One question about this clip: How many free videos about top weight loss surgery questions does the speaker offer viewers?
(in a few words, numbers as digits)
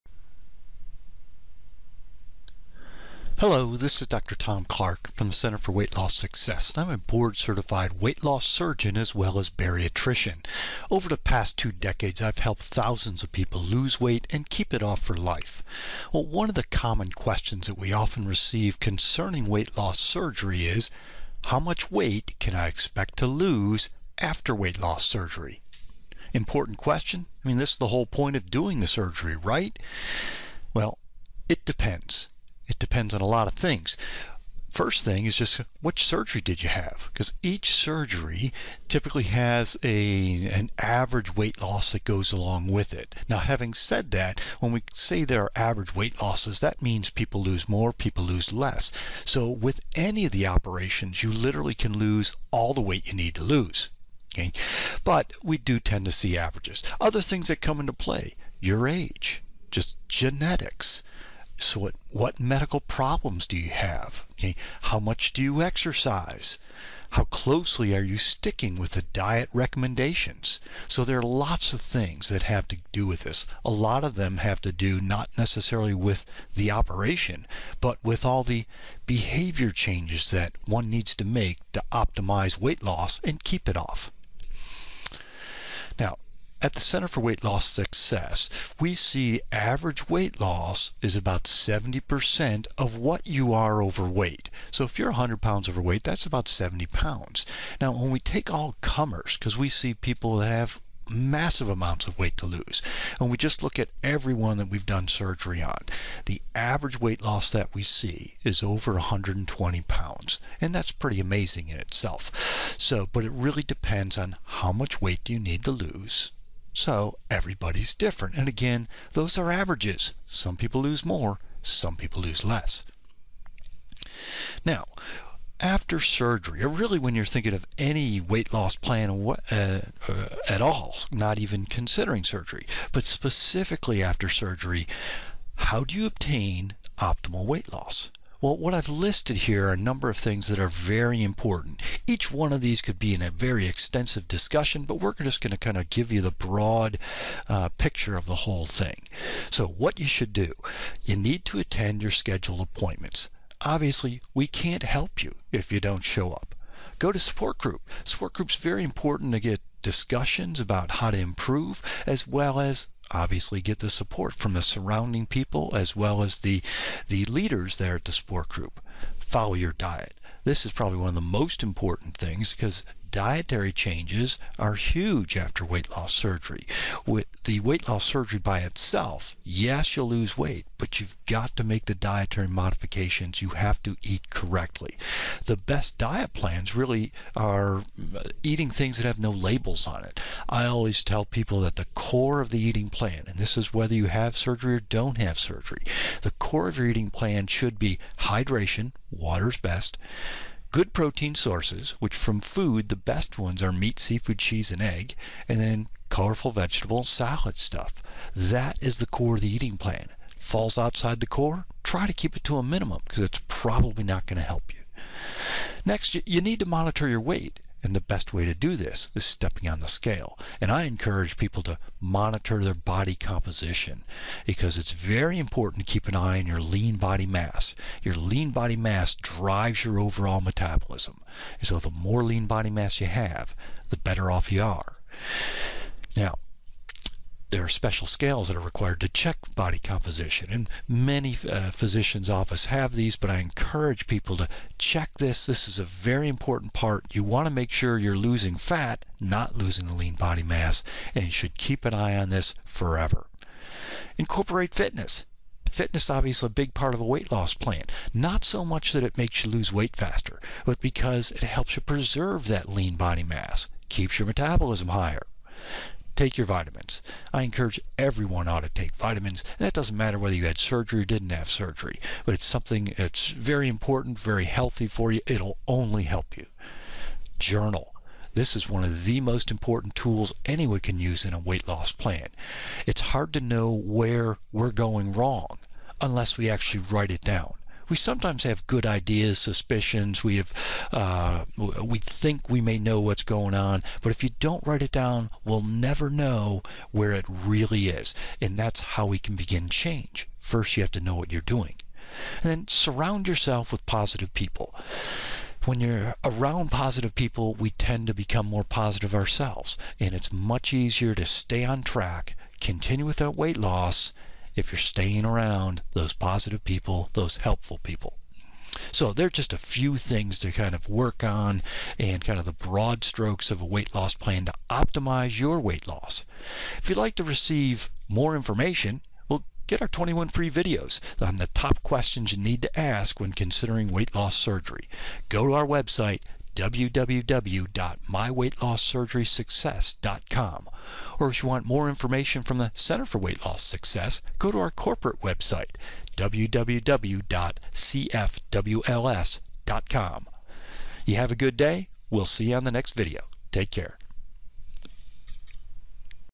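21.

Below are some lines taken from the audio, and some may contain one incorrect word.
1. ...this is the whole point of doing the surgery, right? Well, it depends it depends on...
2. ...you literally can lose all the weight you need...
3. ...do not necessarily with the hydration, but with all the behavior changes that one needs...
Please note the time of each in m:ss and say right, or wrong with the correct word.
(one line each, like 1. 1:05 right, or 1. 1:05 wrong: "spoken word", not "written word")
1. 0:27 right
2. 0:51 right
3. 1:14 wrong: "operation", not "hydration".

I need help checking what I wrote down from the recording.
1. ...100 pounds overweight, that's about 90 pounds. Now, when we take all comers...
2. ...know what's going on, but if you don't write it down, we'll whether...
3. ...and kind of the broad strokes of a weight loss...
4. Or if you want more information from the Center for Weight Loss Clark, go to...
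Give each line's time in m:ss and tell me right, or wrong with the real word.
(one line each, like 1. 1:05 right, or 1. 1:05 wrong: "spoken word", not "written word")
1. 1:35 wrong: "70", not "90"
2. 4:52 wrong: "never", not "whether"
3. 5:21 right
4. 5:41 wrong: "Success", not "Clark".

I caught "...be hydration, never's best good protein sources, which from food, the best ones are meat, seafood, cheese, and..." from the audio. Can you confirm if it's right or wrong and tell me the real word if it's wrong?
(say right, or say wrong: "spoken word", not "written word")
wrong: "water", not "never".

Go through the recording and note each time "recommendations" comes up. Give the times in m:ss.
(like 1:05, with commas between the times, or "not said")
1:09.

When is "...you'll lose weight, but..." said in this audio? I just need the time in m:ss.
2:59.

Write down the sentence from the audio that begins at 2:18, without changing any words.
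Well, what I've listed here are a number of things that are very important.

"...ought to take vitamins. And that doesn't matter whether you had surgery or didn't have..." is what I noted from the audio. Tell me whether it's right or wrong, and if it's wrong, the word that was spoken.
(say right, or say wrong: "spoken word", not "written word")
right.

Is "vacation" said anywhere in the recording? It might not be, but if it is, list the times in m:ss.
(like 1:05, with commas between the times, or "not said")
not said.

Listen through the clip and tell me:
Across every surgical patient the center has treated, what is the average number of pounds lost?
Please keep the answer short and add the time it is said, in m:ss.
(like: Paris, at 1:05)
over 120 pounds, at 1:48.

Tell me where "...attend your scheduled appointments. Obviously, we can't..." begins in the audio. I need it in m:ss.
2:31.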